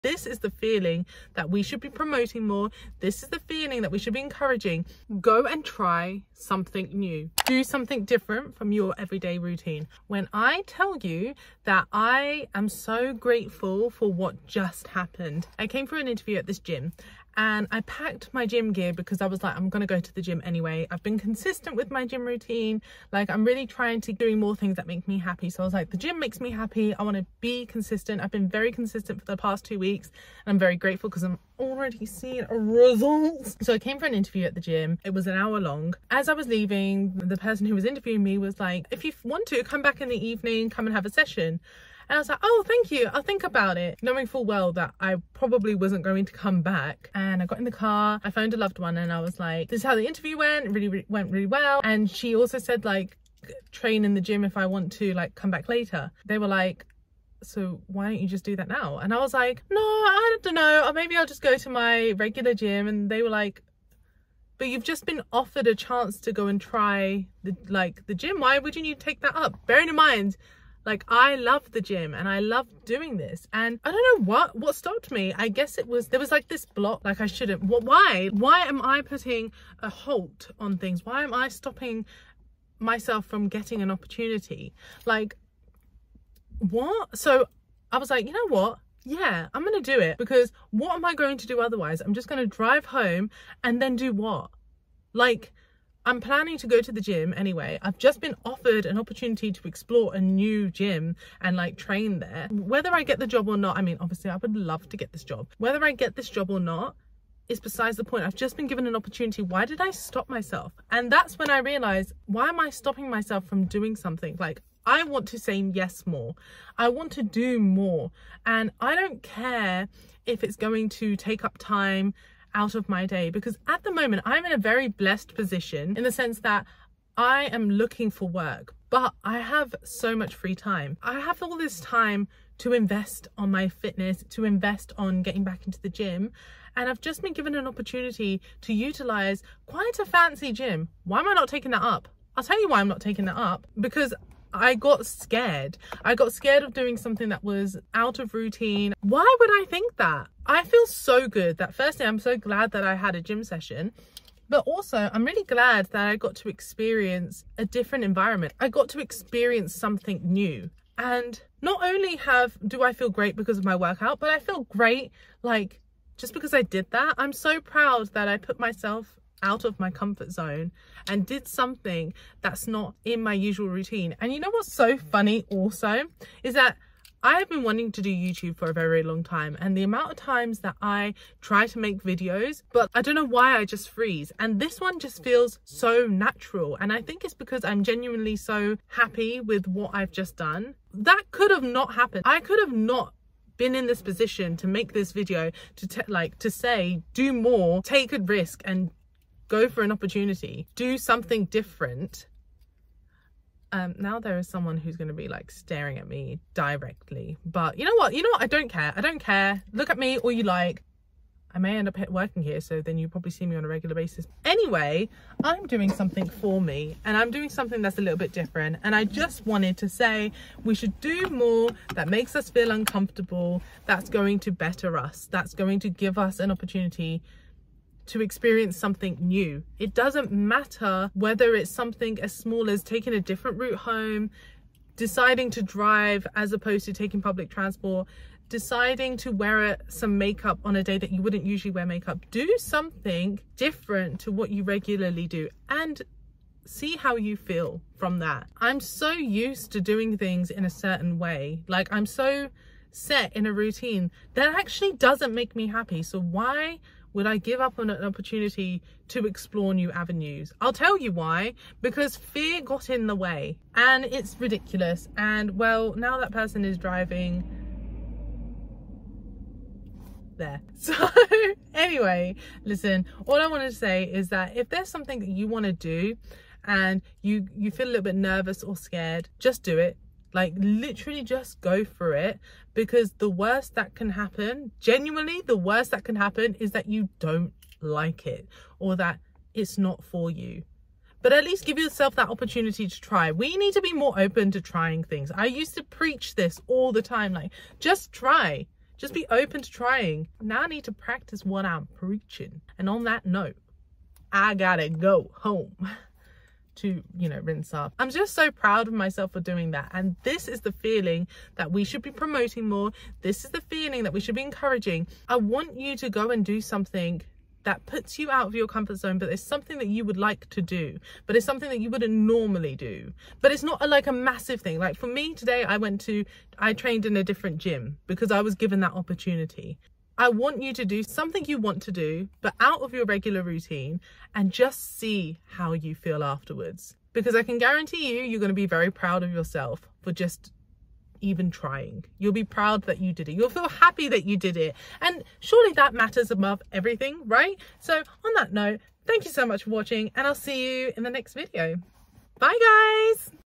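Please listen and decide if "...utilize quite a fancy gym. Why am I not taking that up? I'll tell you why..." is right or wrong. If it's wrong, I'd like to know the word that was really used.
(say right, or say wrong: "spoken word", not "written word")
right.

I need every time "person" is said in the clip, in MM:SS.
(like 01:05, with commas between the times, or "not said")
00:37, 04:26.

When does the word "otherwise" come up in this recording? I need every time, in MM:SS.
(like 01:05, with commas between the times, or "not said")
01:31.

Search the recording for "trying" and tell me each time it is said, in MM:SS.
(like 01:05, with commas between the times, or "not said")
00:23, 04:54, 04:59, 05:41.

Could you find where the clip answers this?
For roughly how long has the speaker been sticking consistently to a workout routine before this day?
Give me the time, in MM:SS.
00:29.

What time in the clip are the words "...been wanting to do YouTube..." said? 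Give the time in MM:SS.
02:57.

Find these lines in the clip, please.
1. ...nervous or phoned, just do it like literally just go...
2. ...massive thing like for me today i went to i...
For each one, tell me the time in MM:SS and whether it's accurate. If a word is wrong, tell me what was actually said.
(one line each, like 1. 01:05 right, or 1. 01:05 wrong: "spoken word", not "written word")
1. 04:38 wrong: "scared", not "phoned"
2. 05:24 right.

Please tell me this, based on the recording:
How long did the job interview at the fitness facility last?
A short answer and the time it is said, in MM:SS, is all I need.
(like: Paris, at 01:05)
An hour, at 00:35.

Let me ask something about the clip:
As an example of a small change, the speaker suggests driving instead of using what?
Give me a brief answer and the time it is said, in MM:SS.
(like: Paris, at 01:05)
Public transport, at 03:57.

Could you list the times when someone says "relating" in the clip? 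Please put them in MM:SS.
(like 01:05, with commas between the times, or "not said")
not said.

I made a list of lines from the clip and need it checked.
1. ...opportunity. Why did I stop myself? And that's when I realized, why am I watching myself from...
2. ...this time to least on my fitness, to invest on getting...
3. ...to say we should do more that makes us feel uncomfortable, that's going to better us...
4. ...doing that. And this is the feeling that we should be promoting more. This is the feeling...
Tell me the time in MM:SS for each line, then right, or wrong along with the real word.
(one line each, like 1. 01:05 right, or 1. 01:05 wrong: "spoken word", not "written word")
1. 01:48 wrong: "stopping", not "watching"
2. 02:11 wrong: "invest", not "least"
3. 03:39 right
4. 05:09 right.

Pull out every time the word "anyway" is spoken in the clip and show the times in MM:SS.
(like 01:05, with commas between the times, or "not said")
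00:20, 01:37, 03:34, 04:31.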